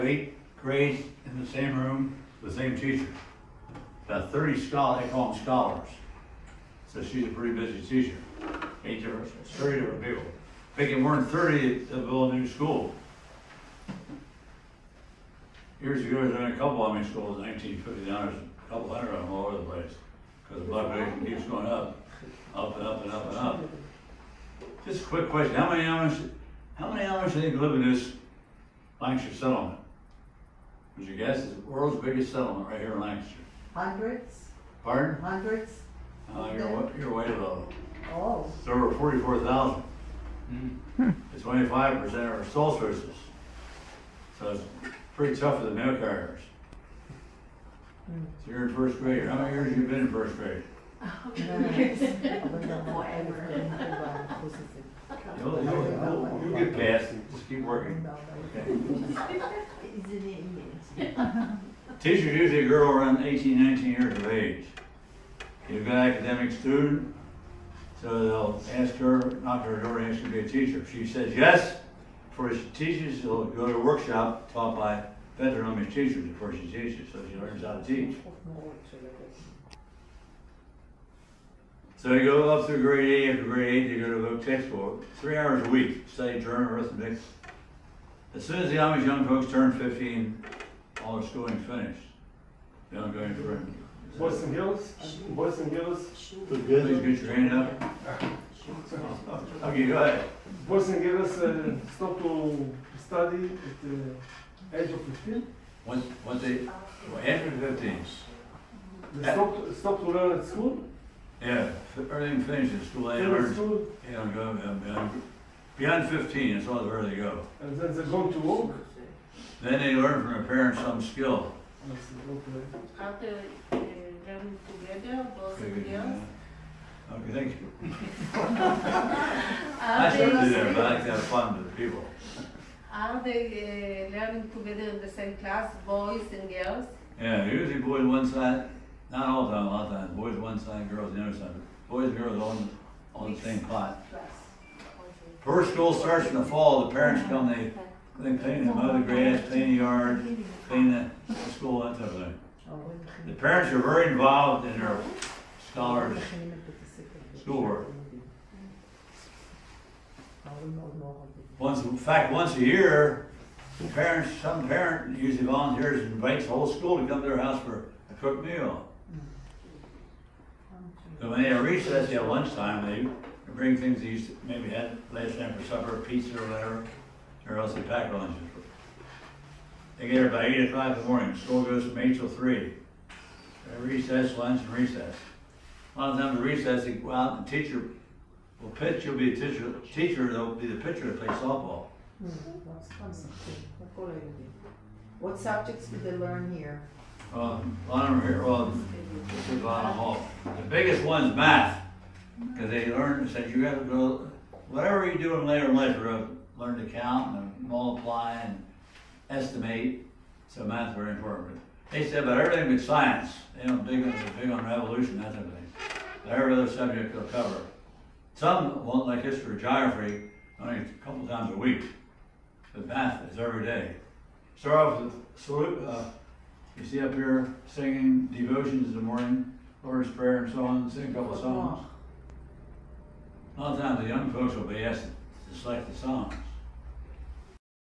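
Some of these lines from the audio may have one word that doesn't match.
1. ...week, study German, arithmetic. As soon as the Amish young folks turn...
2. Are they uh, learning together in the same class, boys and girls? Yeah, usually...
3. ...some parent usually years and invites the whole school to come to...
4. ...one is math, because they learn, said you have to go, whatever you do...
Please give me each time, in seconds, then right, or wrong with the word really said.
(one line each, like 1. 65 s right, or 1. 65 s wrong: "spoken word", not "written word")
1. 85 s right
2. 132 s right
3. 164 s wrong: "volunteers", not "years"
4. 201 s right.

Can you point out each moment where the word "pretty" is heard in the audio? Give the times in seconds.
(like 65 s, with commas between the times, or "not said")
7 s, 45 s.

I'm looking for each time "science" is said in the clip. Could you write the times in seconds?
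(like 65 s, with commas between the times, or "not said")
212 s.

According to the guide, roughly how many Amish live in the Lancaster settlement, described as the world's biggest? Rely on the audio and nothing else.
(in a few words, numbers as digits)
over 44,000.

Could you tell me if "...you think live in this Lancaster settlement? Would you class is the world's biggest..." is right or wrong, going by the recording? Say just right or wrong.
wrong.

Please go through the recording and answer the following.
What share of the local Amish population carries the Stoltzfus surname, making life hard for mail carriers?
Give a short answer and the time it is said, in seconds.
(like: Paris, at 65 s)
25 percent, at 41 s.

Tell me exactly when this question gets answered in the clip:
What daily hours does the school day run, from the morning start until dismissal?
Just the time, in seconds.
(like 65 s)
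181 s.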